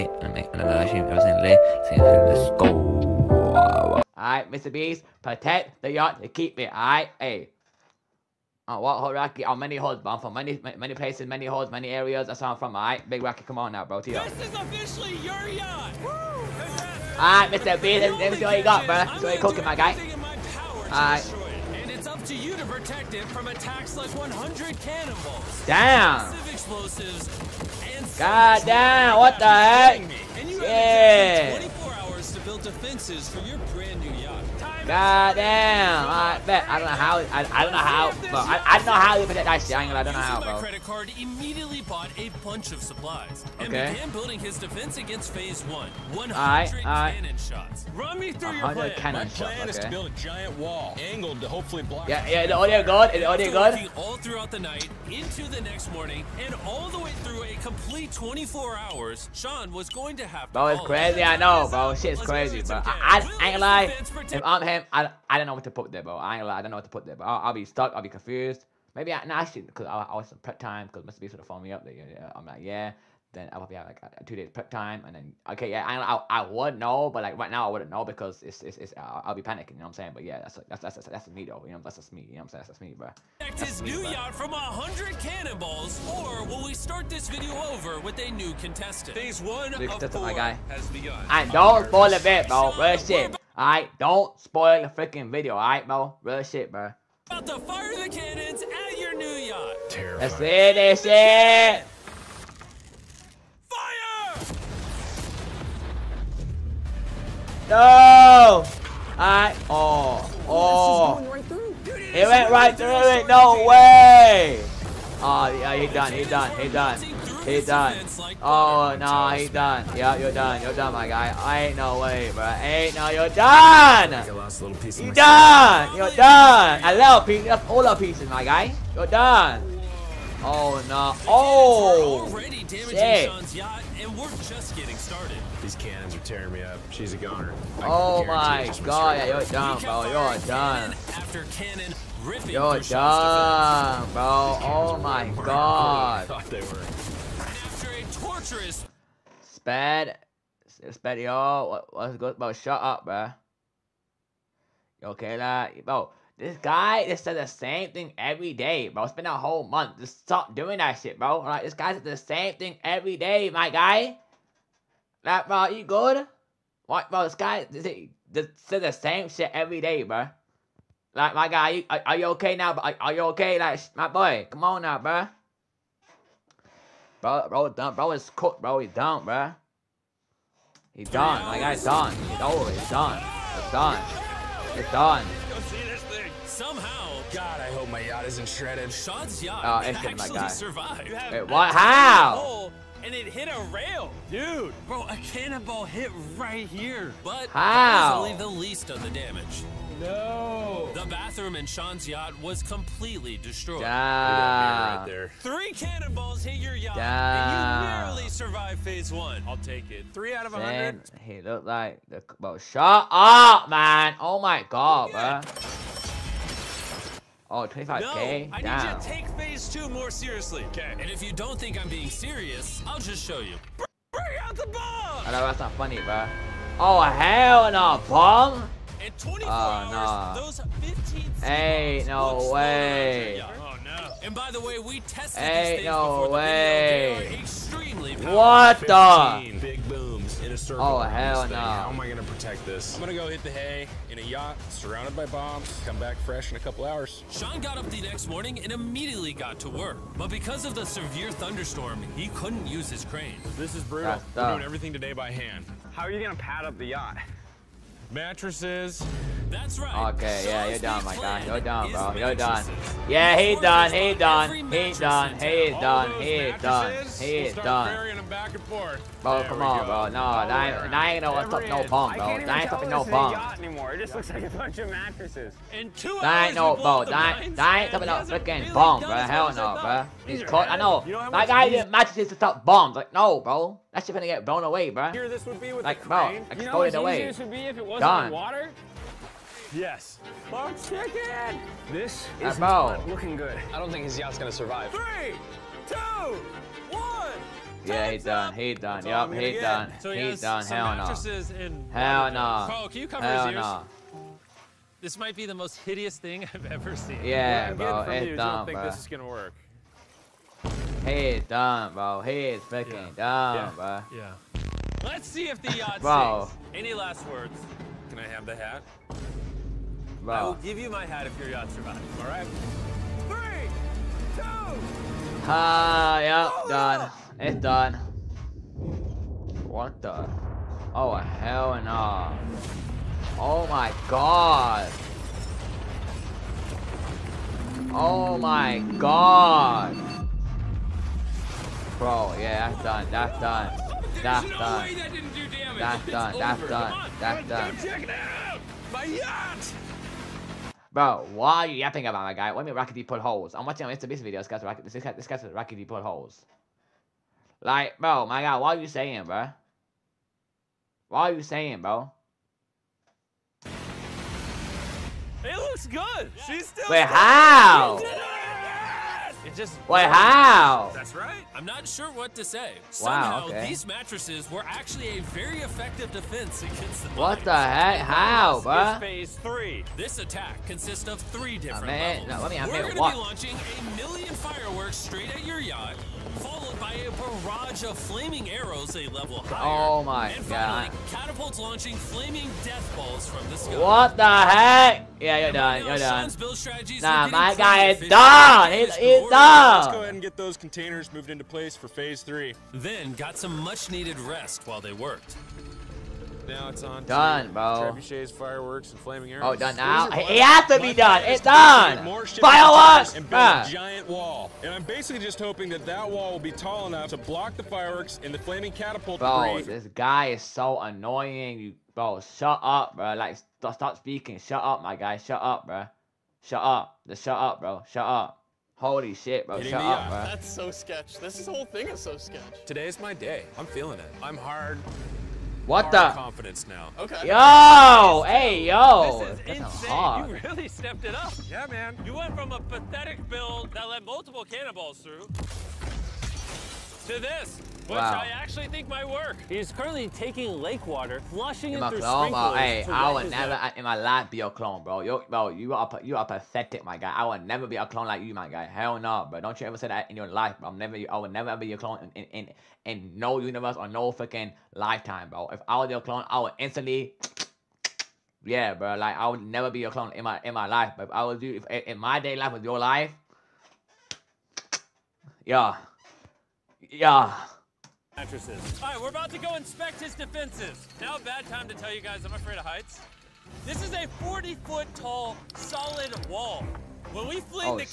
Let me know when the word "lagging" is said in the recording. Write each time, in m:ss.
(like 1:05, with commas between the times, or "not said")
not said.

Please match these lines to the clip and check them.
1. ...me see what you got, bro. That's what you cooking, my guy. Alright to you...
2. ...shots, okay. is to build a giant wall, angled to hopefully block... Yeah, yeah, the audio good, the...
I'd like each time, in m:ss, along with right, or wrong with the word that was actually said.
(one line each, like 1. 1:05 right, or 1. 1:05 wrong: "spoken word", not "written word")
1. 0:18 right
2. 0:49 right.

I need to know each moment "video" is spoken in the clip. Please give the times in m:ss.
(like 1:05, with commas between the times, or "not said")
1:27, 1:35, 5:54.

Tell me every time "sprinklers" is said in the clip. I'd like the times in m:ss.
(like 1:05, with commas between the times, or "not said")
7:32.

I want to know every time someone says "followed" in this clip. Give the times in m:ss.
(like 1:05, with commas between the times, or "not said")
6:26.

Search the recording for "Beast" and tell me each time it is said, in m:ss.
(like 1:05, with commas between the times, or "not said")
0:04, 0:17, 1:11, 5:54.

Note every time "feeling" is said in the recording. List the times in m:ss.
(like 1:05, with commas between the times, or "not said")
7:13.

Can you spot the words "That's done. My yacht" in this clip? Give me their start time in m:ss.
5:47.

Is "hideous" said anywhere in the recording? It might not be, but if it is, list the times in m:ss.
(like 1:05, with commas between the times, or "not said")
5:05.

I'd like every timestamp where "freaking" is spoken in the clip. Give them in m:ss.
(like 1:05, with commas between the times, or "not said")
1:34, 4:38, 7:44.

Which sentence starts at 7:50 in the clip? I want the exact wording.
But if I was you, if, in my day life was your life, yeah, yeah mattresses.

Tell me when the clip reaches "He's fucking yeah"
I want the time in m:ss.
5:12.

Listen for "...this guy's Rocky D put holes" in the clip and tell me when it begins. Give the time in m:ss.
5:55.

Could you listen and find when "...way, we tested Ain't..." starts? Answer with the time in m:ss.
3:54.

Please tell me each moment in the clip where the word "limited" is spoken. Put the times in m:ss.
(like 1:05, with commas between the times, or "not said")
not said.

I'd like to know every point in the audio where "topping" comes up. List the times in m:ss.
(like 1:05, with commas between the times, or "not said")
4:32, 4:37.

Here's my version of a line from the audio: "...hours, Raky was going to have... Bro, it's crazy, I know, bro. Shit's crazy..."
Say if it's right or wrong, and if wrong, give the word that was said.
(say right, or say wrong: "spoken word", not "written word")
wrong: "Sean", not "Raky".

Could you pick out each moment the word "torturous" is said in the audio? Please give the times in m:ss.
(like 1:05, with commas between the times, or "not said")
2:28.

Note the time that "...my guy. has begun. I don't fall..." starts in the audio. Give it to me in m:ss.
1:30.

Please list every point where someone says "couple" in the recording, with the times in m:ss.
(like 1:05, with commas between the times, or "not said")
4:06.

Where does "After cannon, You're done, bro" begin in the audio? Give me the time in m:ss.
2:21.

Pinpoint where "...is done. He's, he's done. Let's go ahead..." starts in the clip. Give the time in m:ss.
6:37.